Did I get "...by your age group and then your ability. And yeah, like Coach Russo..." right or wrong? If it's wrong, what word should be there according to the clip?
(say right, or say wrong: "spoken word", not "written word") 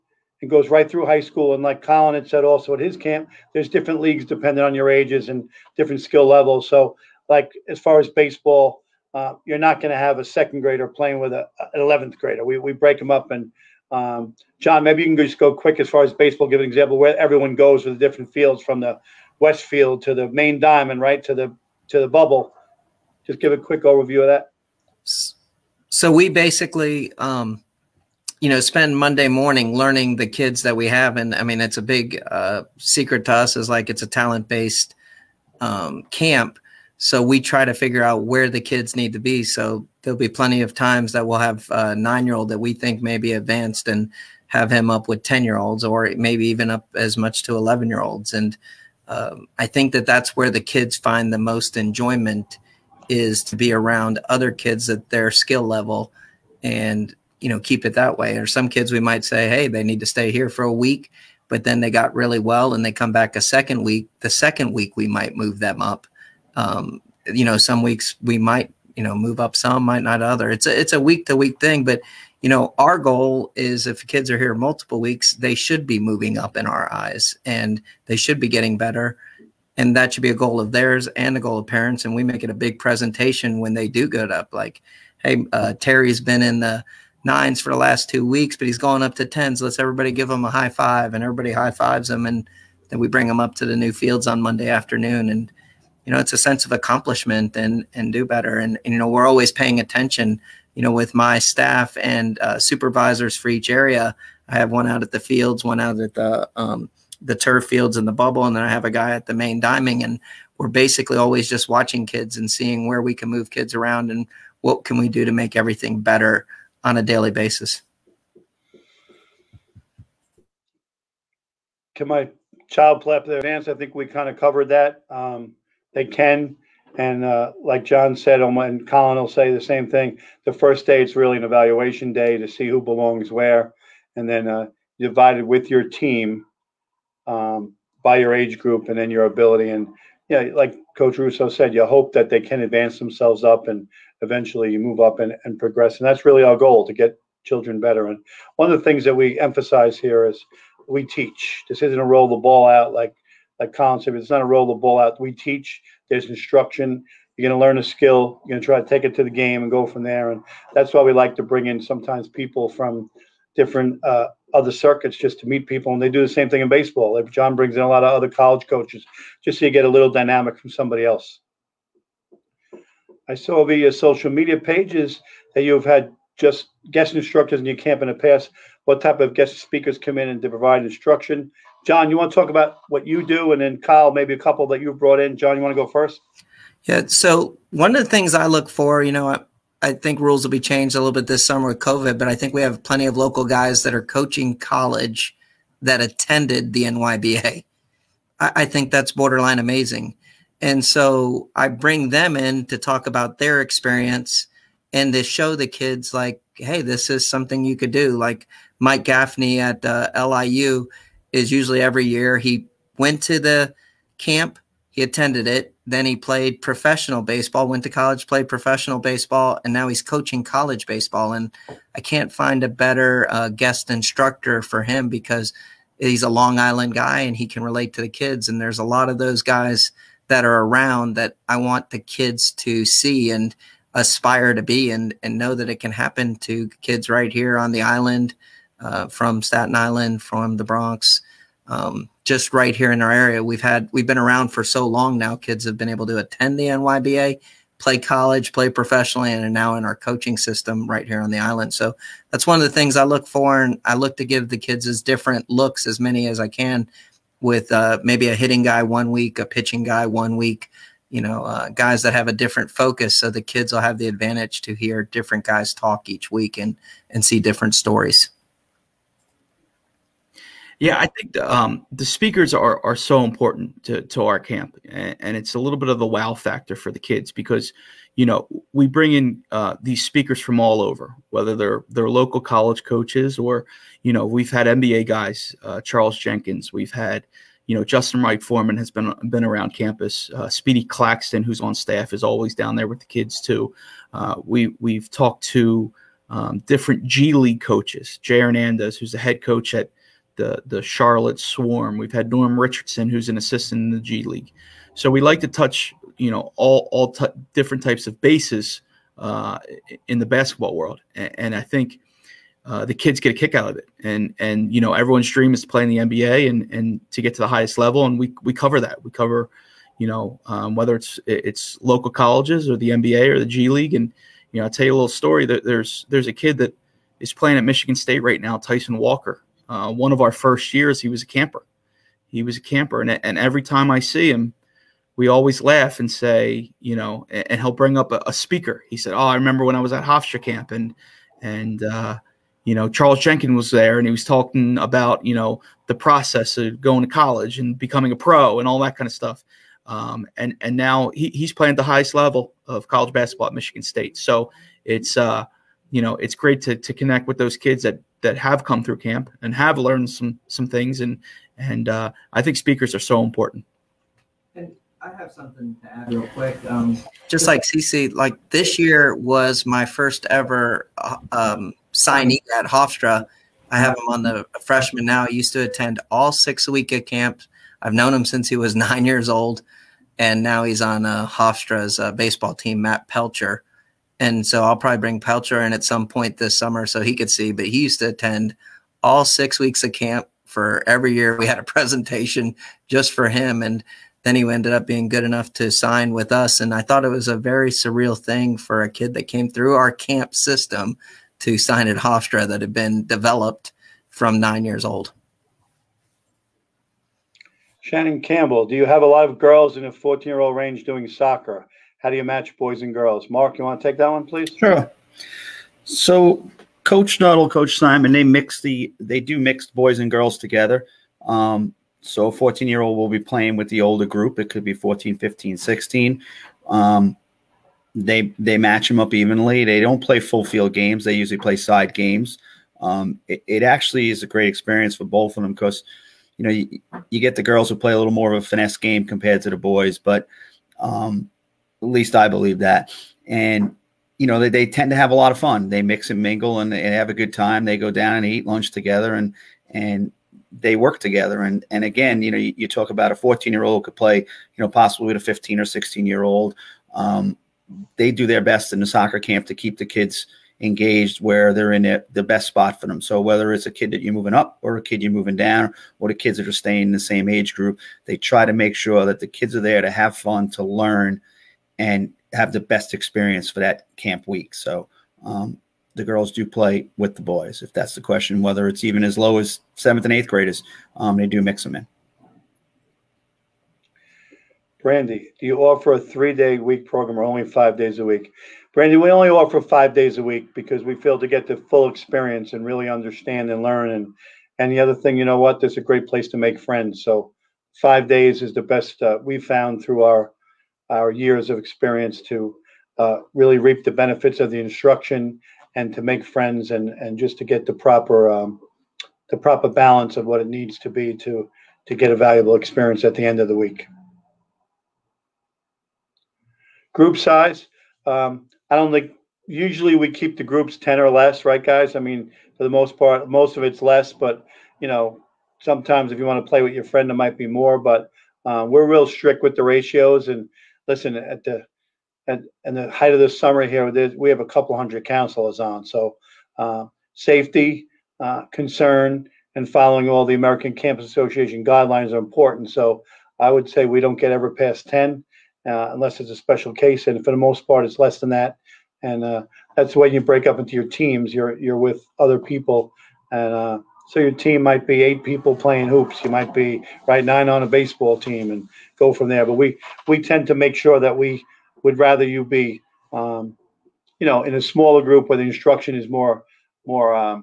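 right.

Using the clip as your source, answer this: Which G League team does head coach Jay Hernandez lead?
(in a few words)
Charlotte Swarm.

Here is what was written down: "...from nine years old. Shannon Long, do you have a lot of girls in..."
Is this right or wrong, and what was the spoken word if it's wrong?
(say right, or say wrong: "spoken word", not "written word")
wrong: "Campbell", not "Long".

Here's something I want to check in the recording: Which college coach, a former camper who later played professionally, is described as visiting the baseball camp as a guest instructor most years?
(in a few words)
Mike Gaffney.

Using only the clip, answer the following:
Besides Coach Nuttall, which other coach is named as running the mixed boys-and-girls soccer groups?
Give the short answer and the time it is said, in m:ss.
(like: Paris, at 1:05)
Coach Simon, at 6:57.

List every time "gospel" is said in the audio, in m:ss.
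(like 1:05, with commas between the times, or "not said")
not said.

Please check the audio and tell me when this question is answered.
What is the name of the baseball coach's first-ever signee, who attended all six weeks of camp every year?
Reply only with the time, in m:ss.
6:22.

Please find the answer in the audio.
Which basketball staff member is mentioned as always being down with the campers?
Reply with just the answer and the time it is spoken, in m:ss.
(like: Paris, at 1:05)
Speedy Claxton, at 4:50.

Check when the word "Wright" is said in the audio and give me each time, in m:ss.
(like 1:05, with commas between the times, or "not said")
4:48.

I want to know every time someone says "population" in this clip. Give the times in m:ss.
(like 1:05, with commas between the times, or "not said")
not said.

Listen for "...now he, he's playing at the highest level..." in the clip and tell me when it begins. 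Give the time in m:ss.
5:50.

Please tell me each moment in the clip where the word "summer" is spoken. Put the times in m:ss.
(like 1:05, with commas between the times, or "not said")
3:11, 6:26, 8:53.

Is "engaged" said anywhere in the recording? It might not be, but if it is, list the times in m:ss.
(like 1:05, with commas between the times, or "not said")
7:40.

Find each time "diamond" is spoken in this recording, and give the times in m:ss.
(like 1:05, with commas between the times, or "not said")
0:20, 1:49.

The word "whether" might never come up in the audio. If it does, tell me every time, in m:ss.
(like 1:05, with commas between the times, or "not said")
4:41, 5:20, 7:43, 7:58.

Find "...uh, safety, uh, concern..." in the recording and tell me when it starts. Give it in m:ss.
8:56.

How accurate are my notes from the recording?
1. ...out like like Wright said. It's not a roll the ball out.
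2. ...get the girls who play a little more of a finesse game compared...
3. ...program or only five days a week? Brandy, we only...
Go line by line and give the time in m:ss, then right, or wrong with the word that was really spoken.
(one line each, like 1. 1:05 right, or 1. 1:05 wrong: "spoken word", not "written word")
1. 2:32 wrong: "Colin", not "Wright"
2. 7:17 right
3. 8:06 right.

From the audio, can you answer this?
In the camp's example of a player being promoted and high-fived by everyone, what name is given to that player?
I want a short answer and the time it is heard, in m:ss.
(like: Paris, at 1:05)
Terry, at 1:25.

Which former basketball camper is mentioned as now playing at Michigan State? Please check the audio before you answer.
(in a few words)
Tyson Walker.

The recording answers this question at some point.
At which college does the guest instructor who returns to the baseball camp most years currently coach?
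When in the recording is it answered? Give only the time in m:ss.
3:30.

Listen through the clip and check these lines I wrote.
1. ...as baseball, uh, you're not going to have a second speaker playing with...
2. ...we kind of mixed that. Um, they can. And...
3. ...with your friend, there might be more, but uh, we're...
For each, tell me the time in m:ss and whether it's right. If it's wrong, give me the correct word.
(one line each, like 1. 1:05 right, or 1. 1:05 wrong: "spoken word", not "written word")
1. 0:07 wrong: "grader", not "speaker"
2. 2:03 wrong: "covered", not "mixed"
3. 8:46 right.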